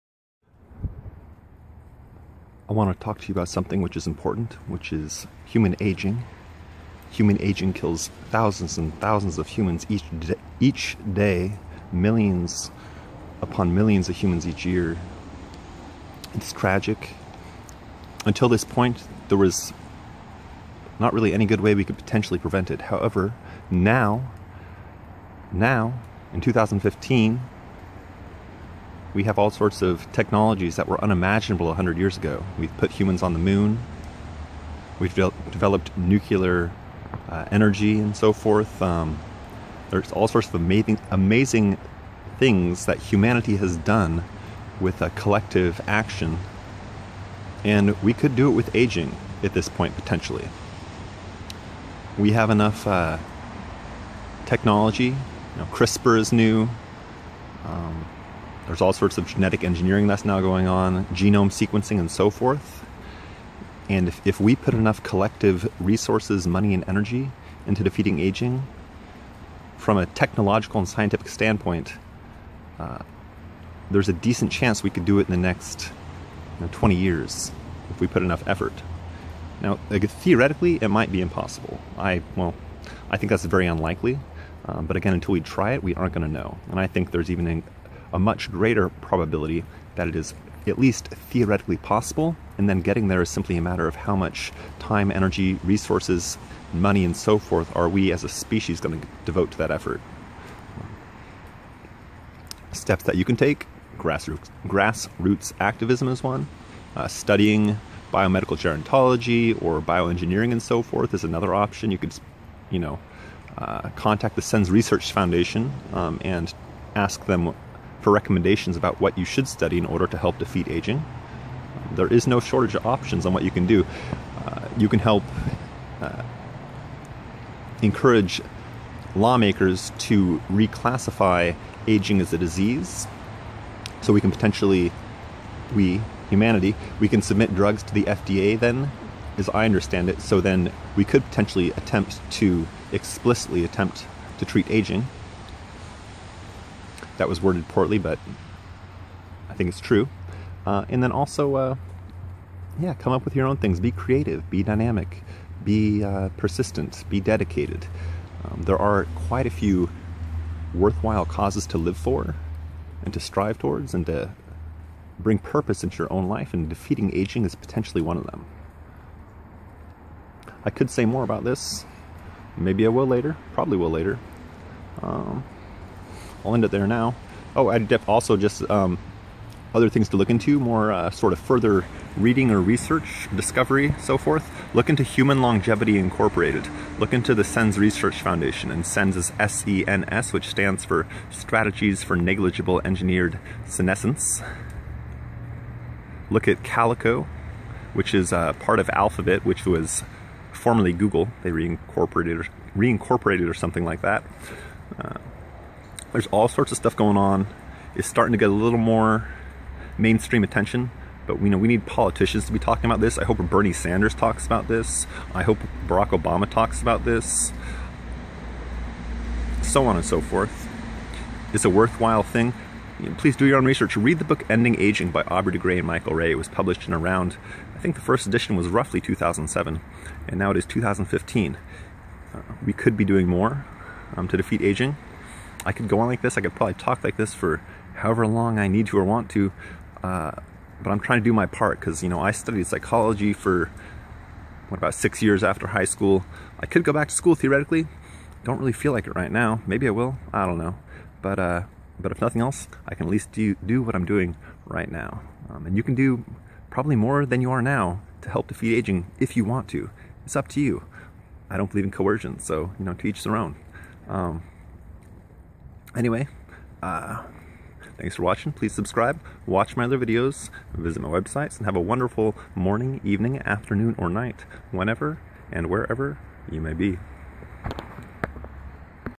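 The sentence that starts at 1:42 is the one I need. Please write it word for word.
Steps that you can take grassroots, grassroots activism is one, uh, studying biomedical gerontology or bioengineering and so forth is another option.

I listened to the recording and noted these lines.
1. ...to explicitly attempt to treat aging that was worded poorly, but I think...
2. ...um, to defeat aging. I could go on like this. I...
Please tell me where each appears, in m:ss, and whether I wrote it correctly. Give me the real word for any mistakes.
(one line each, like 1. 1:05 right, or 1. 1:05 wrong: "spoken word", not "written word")
1. 2:22 right
2. 3:54 right.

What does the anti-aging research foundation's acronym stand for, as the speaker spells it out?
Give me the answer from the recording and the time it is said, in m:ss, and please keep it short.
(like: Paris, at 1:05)
Strategies for Negligible Engineered Senescence, at 3:11.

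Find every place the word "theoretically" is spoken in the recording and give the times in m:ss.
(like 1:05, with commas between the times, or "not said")
1:20, 1:31, 4:07.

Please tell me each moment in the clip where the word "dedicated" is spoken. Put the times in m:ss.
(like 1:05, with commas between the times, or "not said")
2:37.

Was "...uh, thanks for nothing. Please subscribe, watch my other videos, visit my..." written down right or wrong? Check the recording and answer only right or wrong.
wrong.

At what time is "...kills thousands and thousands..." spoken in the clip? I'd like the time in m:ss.
0:07.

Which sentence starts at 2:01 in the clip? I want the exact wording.
There is no shortage of options on what you can do.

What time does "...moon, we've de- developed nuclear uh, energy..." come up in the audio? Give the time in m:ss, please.
0:33.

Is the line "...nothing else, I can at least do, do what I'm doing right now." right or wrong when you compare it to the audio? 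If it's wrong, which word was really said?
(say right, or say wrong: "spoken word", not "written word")
right.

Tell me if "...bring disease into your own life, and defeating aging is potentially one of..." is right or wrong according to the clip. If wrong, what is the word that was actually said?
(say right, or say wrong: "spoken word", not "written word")
wrong: "purpose", not "disease".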